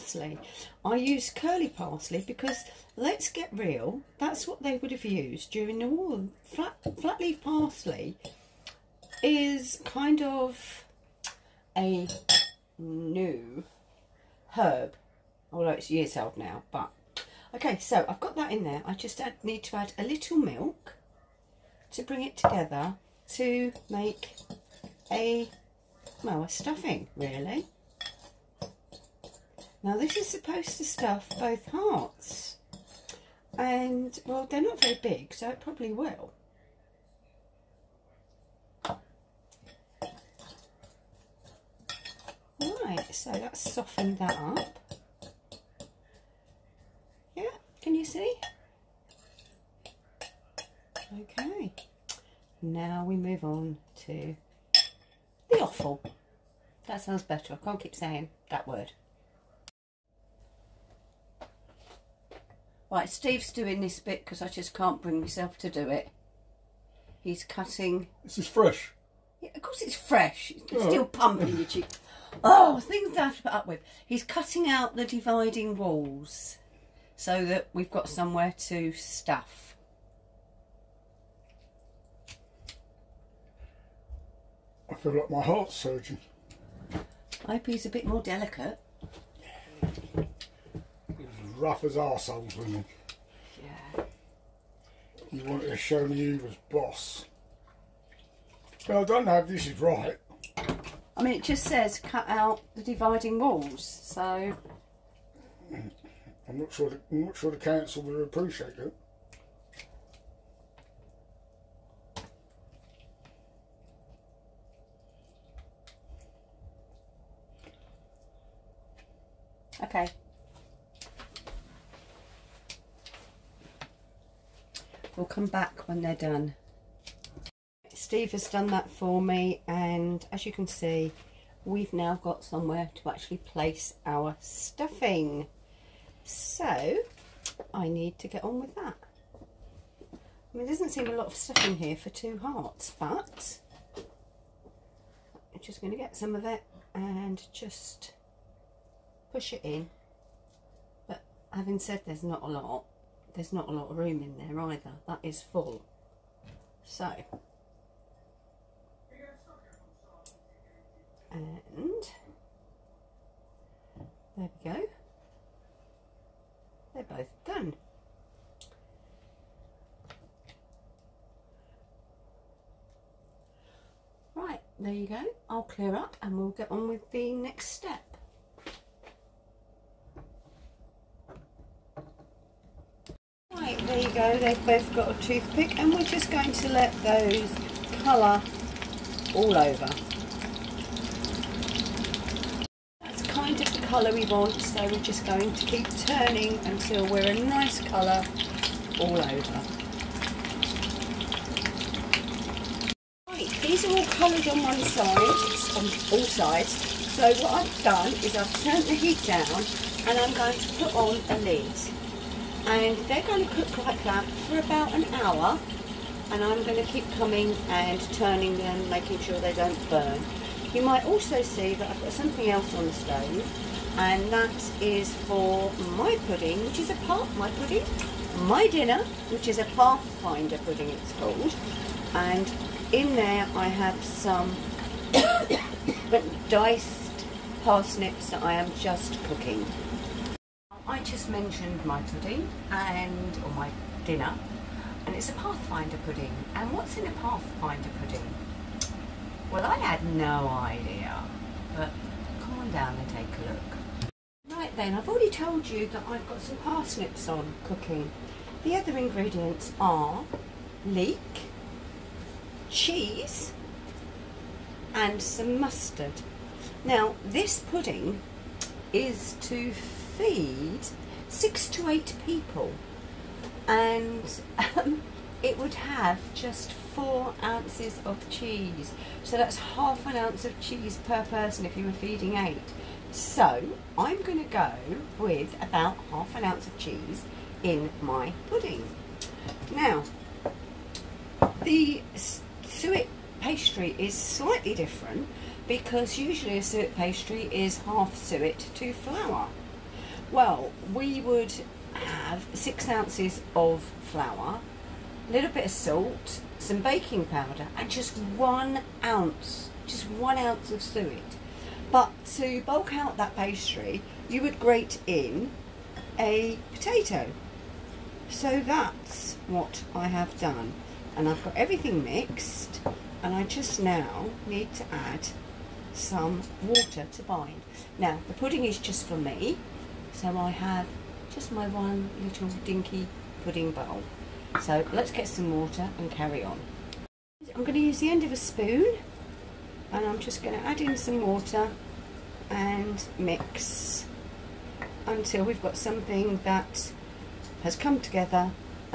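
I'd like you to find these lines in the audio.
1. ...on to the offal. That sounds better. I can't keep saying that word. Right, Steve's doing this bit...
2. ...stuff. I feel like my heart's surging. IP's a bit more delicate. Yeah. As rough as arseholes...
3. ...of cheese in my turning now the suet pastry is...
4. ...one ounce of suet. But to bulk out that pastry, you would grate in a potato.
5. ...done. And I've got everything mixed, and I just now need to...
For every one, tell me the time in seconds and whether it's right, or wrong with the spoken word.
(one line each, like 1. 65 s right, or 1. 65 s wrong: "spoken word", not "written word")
1. 53 s right
2. 78 s right
3. 286 s wrong: "pudding", not "turning"
4. 310 s right
5. 320 s right.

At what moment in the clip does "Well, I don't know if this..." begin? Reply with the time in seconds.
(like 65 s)
98 s.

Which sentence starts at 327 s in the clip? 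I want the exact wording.
Now, the pudding is just for me, so I have just my one little dinky pudding bowl.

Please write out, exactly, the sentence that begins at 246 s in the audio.
And what's in a Pathfinder pudding?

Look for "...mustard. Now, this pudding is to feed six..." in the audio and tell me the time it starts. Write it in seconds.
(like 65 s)
265 s.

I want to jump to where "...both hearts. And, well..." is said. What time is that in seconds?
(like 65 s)
31 s.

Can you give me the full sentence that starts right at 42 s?
Right, so that's softened that up.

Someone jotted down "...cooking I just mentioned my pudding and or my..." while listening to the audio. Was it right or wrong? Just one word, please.
right.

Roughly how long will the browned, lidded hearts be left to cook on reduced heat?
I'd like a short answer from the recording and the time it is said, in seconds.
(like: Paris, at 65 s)
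About an hour, at 214 s.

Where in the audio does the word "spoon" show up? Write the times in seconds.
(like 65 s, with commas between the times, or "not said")
338 s.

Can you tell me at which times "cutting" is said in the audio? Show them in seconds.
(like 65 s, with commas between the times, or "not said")
67 s, 74 s.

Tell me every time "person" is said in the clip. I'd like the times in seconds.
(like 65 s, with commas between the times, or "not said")
281 s.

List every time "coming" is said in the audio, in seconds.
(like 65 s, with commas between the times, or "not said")
217 s.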